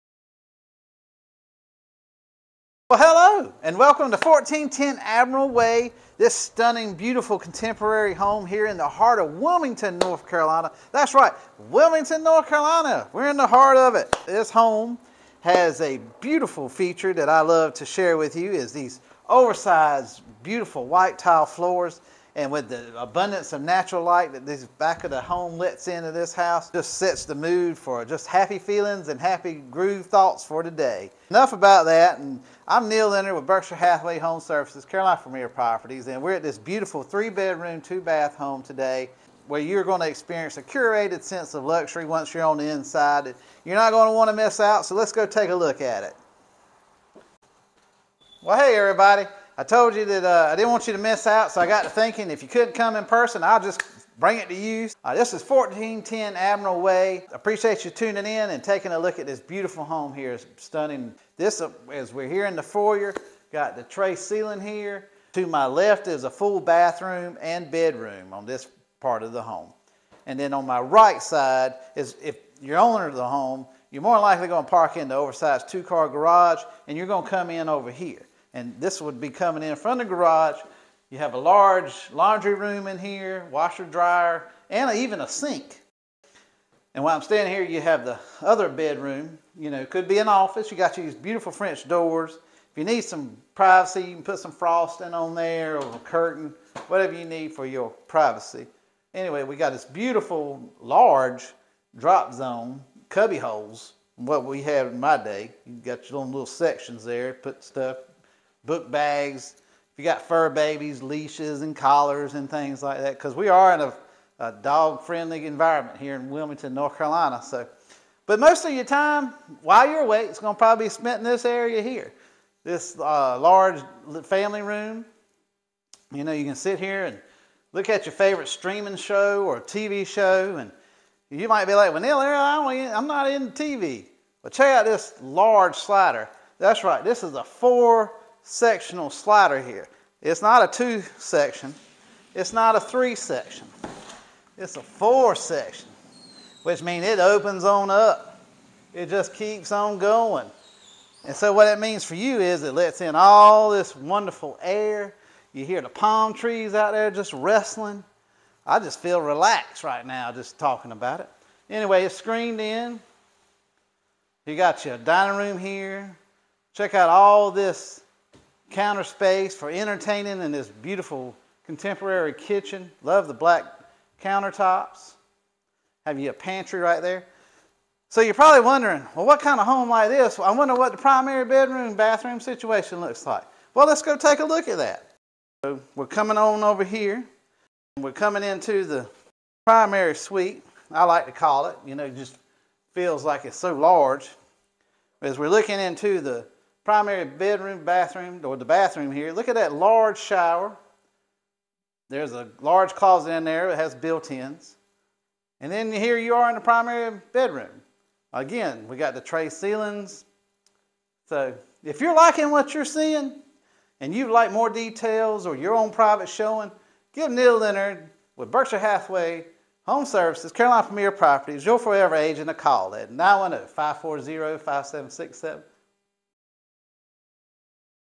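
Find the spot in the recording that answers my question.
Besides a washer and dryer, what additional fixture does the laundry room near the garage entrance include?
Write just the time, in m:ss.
1:25.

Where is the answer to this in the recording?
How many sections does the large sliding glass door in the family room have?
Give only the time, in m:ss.
2:24.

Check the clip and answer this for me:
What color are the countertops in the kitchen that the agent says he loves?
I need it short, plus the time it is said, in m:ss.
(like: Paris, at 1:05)
Black, at 2:53.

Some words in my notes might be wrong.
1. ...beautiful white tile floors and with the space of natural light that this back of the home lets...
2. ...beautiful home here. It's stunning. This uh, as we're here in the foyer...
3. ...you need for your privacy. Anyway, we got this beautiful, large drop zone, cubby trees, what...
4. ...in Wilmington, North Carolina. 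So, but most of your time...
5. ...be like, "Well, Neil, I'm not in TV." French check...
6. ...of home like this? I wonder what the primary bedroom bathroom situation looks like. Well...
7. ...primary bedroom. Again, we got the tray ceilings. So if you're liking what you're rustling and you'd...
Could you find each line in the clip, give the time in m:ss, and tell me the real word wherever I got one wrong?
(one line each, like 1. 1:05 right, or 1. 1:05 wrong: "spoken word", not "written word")
1. 0:20 wrong: "abundance", not "space"
2. 0:59 right
3. 1:37 wrong: "holes", not "trees"
4. 1:56 right
5. 2:11 wrong: "But", not "French"
6. 2:59 right
7. 3:26 wrong: "seeing", not "rustling".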